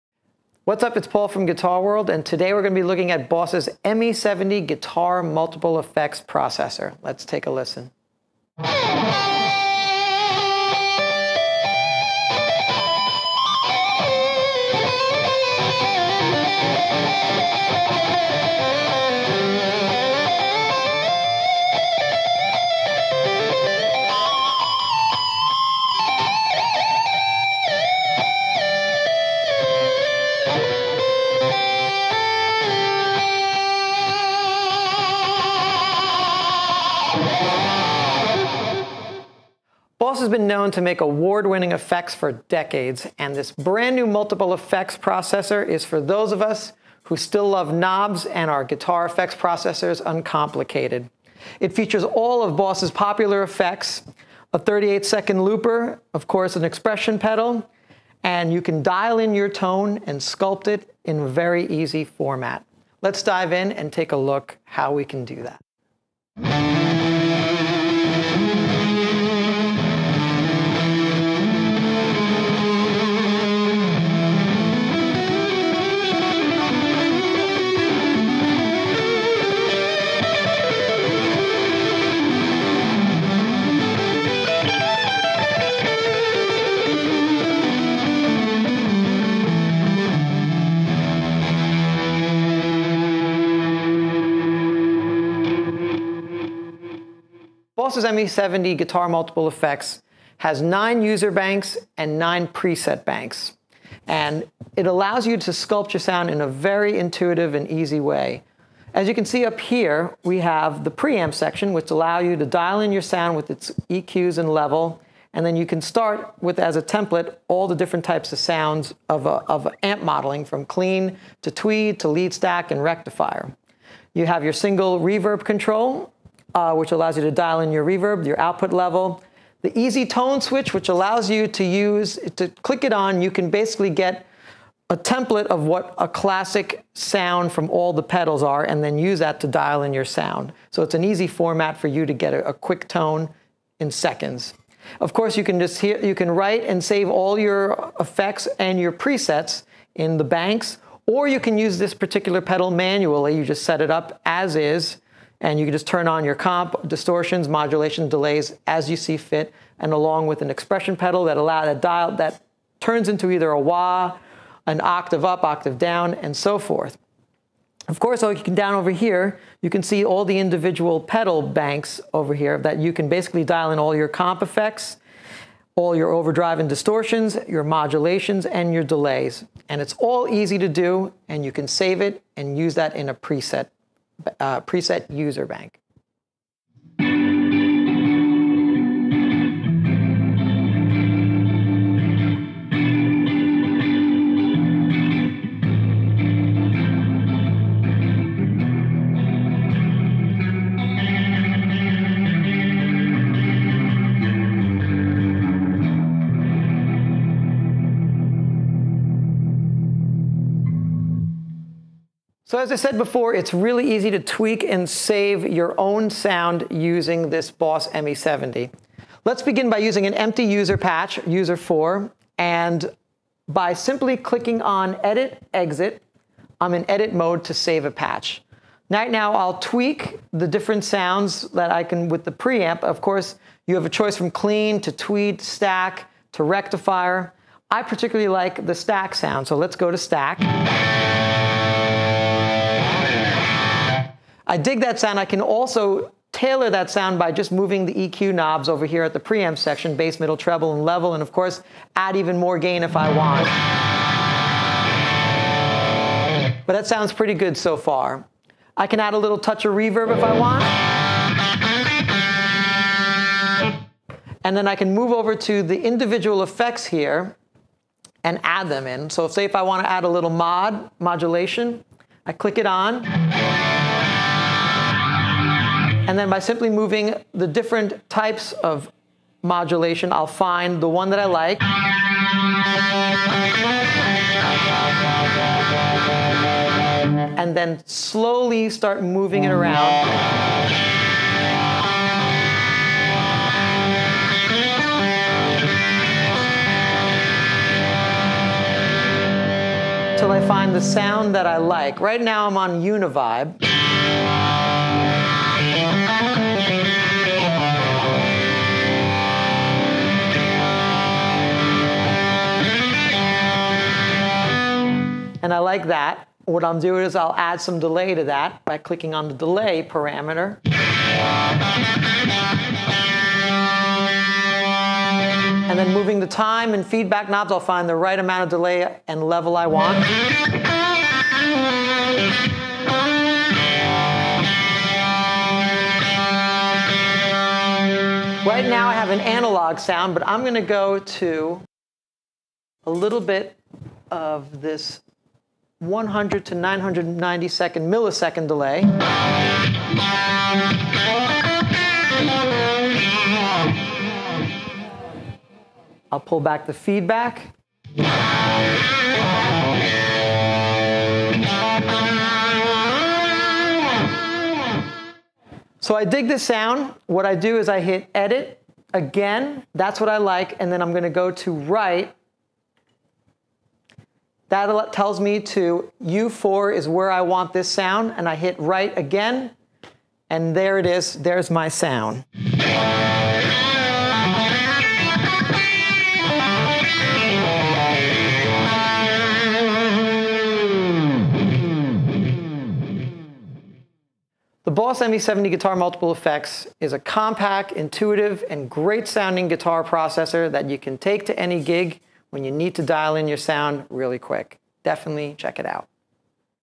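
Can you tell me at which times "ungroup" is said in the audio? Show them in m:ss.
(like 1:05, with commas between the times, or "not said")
not said.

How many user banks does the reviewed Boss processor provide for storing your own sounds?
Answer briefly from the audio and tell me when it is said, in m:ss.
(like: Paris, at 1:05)
9, at 1:40.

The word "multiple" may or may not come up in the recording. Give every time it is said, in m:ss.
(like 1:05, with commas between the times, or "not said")
0:05, 0:44, 1:39, 6:35.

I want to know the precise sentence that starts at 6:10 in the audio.
And then I'm going to go to write.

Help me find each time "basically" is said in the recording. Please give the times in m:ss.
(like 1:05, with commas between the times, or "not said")
2:13, 2:53.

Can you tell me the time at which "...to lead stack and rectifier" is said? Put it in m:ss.
2:01.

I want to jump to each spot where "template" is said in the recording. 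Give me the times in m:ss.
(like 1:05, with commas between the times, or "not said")
1:56, 2:14.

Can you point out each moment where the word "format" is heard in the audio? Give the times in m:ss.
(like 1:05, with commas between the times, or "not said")
1:02, 2:21.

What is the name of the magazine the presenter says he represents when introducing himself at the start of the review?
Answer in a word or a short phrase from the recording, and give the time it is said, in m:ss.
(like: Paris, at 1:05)
Guitar World, at 0:01.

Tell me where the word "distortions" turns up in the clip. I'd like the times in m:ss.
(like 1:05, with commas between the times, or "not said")
2:36, 2:56.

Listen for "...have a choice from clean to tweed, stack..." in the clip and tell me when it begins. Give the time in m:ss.
3:53.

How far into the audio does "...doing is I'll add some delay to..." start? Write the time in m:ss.
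5:16.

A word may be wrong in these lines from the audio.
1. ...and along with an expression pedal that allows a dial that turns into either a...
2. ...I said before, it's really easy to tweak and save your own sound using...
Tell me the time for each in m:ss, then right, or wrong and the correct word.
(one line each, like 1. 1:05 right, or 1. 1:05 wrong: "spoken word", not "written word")
1. 2:39 right
2. 3:32 right.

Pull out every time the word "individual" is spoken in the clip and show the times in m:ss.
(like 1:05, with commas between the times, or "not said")
2:50, 4:25.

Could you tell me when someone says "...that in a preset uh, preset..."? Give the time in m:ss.
3:02.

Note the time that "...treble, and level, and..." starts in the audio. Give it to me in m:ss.
4:10.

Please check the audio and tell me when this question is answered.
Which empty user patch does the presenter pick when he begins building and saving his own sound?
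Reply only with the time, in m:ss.
3:41.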